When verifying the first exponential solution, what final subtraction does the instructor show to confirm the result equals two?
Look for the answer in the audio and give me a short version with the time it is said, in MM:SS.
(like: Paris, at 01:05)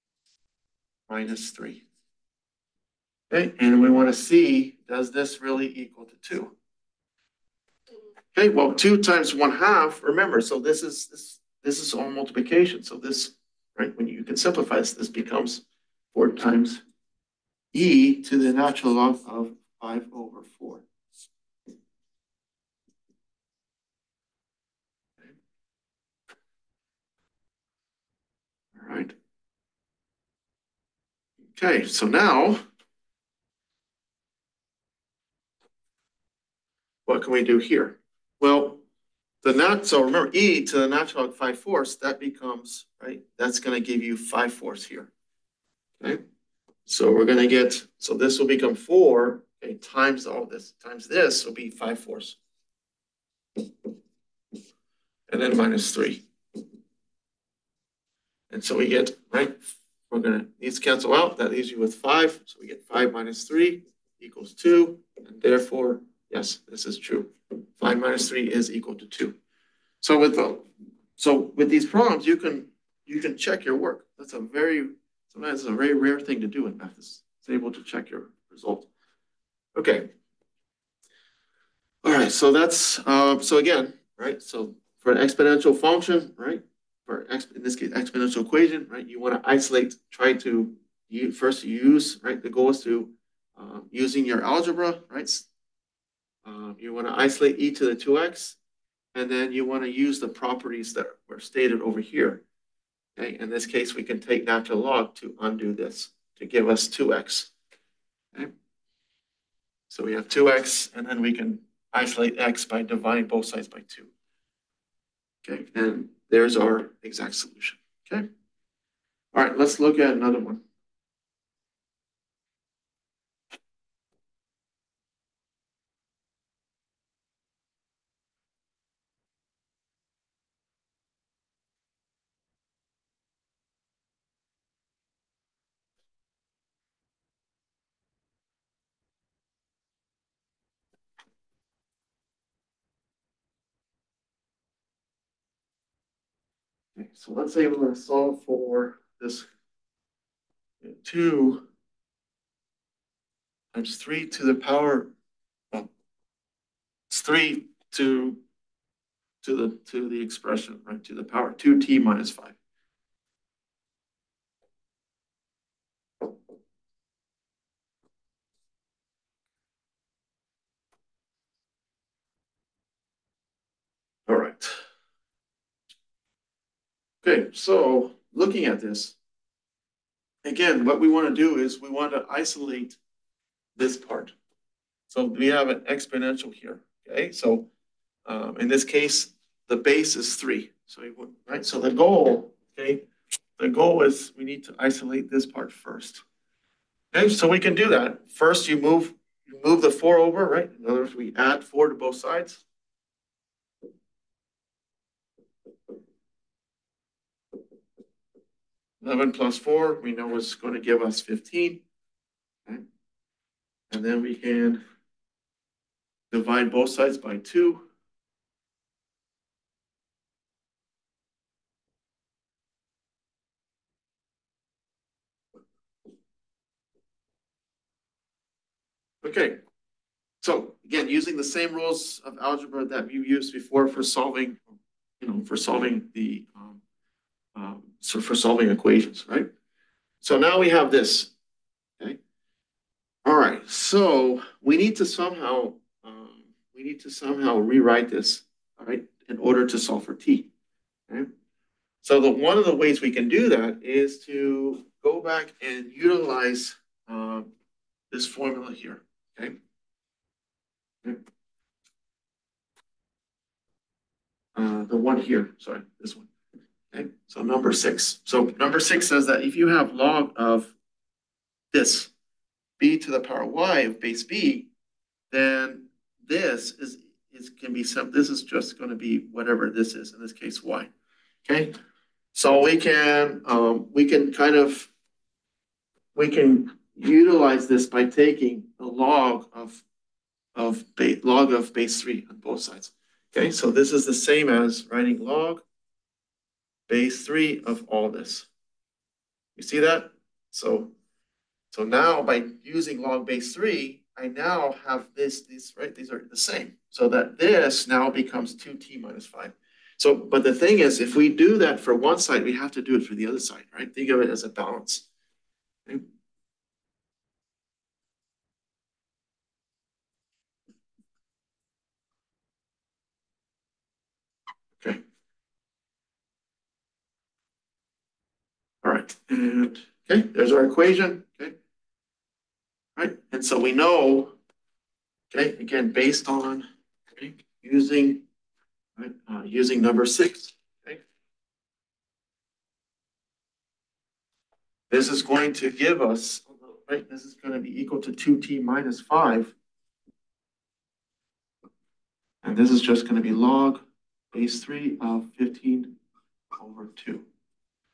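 5 minus 3, at 01:02.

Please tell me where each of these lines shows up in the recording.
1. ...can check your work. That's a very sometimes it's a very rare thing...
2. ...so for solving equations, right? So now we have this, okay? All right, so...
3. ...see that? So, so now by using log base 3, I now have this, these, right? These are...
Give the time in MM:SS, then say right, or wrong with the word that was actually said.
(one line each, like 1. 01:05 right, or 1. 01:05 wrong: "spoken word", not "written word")
1. 01:13 right
2. 03:57 right
3. 04:59 right.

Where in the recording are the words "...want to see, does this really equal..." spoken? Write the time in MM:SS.
00:03.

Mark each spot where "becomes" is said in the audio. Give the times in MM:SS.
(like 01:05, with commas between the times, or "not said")
00:15, 00:42, 00:48, 05:08.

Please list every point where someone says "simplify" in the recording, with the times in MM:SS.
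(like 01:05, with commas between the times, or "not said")
00:14.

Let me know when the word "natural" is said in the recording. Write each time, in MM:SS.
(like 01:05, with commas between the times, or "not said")
00:18, 00:40, 01:44.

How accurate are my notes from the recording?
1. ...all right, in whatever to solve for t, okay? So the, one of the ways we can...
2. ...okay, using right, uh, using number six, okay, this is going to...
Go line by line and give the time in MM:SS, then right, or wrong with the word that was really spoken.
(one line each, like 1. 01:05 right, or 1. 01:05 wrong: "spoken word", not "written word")
1. 04:08 wrong: "order", not "whatever"
2. 05:37 right.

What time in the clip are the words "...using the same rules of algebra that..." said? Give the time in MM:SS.
03:51.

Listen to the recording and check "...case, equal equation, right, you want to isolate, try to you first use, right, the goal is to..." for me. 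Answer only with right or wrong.
wrong.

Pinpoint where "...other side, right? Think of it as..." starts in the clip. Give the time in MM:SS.
05:13.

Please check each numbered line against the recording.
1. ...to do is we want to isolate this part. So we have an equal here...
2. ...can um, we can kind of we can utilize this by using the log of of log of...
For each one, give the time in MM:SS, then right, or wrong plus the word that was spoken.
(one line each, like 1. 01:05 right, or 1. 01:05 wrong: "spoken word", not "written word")
1. 03:01 wrong: "exponential", not "equal"
2. 04:42 wrong: "taking", not "using".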